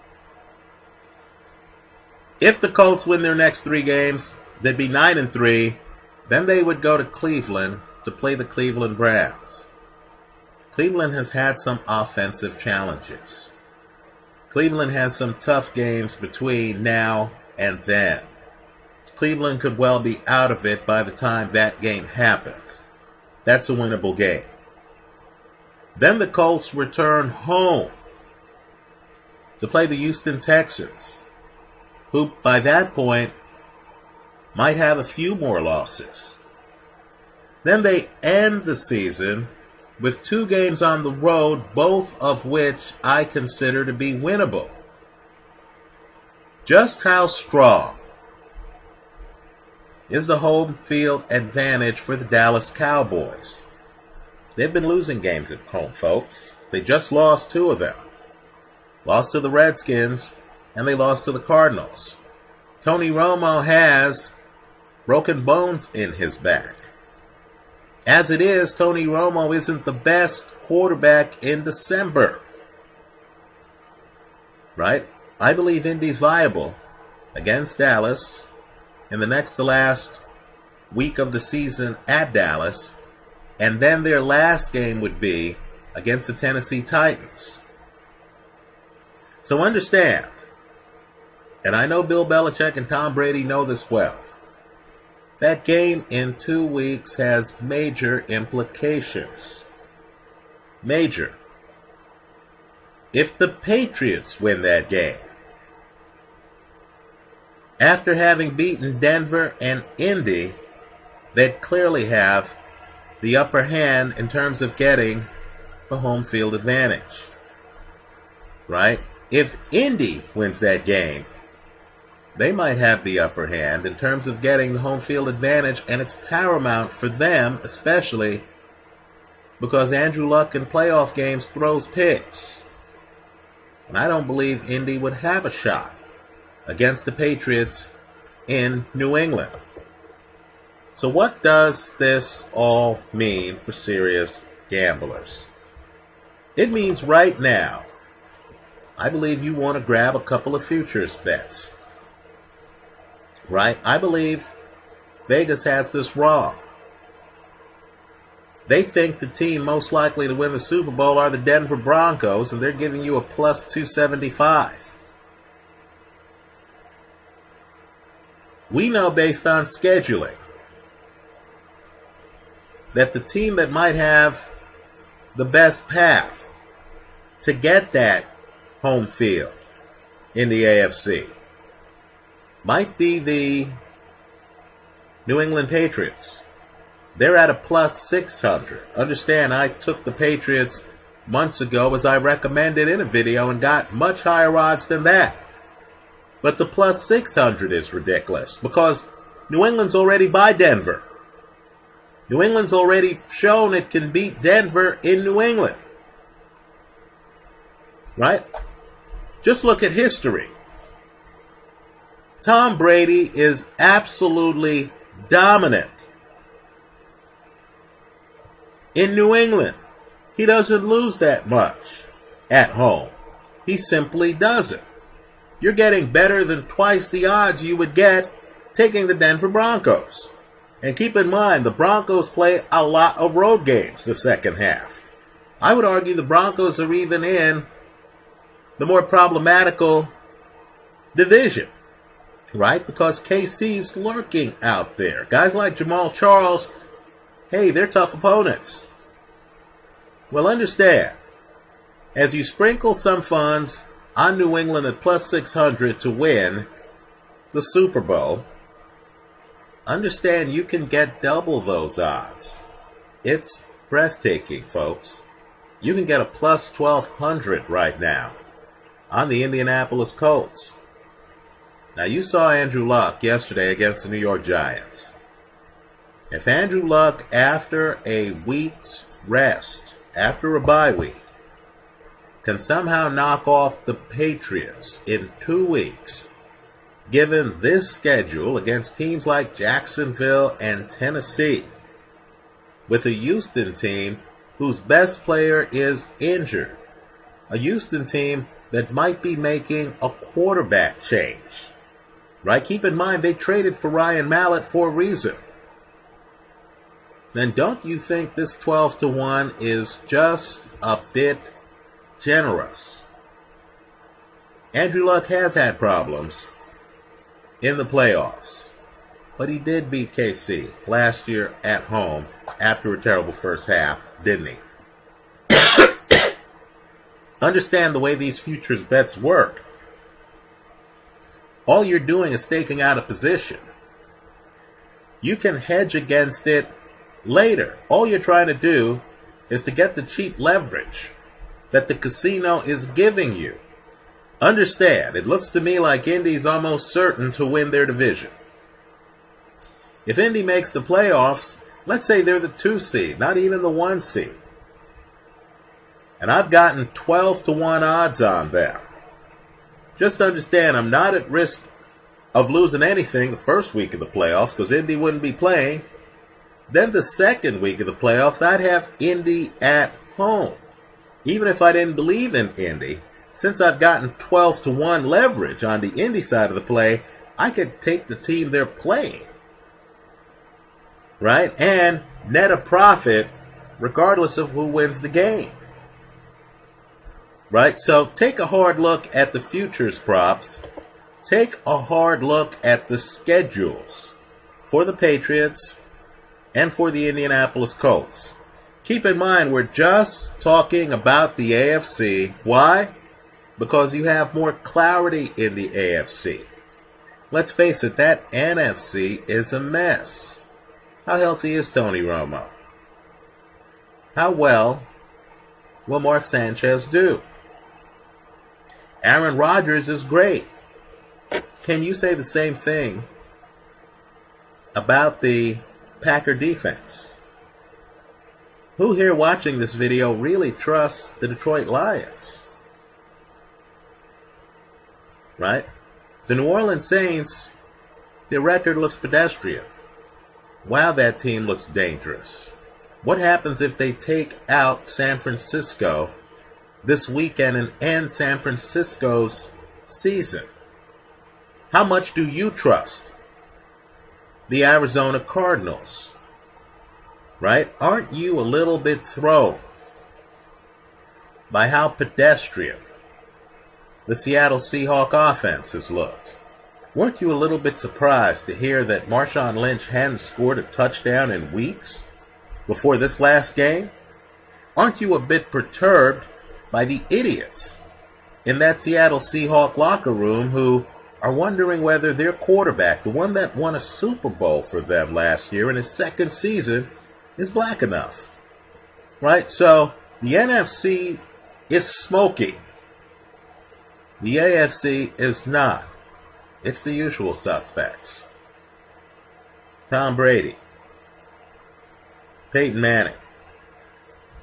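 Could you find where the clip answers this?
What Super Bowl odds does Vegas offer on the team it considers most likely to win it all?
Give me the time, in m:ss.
2:43.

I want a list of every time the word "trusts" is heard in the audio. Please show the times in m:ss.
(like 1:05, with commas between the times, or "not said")
7:10, 7:32.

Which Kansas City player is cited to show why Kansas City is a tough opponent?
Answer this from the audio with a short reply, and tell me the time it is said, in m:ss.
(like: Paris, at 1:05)
Jamaal Charles, at 4:05.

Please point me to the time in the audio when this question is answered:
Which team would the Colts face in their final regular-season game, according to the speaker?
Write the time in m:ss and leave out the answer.
1:26.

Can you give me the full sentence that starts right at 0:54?
They've been losing games at home, folks.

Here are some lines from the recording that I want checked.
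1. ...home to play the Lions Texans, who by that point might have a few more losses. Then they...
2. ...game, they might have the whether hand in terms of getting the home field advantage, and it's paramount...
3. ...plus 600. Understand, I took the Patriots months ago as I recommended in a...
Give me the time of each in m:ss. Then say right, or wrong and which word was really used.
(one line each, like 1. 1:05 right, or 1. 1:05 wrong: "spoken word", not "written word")
1. 0:27 wrong: "Houston", not "Lions"
2. 2:00 wrong: "upper", not "whether"
3. 3:07 right.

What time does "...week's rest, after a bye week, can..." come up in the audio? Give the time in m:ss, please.
4:38.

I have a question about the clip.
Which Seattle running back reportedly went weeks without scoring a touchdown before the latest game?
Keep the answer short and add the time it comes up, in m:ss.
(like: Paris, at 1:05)
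Marshawn Lynch, at 7:49.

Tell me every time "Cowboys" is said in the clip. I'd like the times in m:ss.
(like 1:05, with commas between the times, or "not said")
0:52.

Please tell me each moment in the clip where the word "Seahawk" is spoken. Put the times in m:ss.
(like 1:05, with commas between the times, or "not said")
7:44, 7:59.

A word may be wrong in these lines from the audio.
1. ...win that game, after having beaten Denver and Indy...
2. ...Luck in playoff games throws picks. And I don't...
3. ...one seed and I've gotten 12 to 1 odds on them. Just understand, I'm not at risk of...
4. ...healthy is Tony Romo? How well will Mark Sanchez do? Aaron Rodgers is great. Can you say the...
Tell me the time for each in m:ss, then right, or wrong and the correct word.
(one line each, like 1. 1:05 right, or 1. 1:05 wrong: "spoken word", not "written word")
1. 1:44 right
2. 2:10 right
3. 5:53 right
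4. 6:51 right.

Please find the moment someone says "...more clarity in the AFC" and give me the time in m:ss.
6:44.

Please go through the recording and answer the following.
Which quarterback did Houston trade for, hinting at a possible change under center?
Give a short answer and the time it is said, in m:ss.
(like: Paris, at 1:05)
Ryan Mallett, at 5:03.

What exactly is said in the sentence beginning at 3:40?
He doesn't lose that much at home.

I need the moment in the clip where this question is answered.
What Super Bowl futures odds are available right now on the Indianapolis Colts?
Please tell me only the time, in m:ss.
4:26.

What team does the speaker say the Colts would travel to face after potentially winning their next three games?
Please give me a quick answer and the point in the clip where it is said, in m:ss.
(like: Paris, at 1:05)
Cleveland Browns, at 0:08.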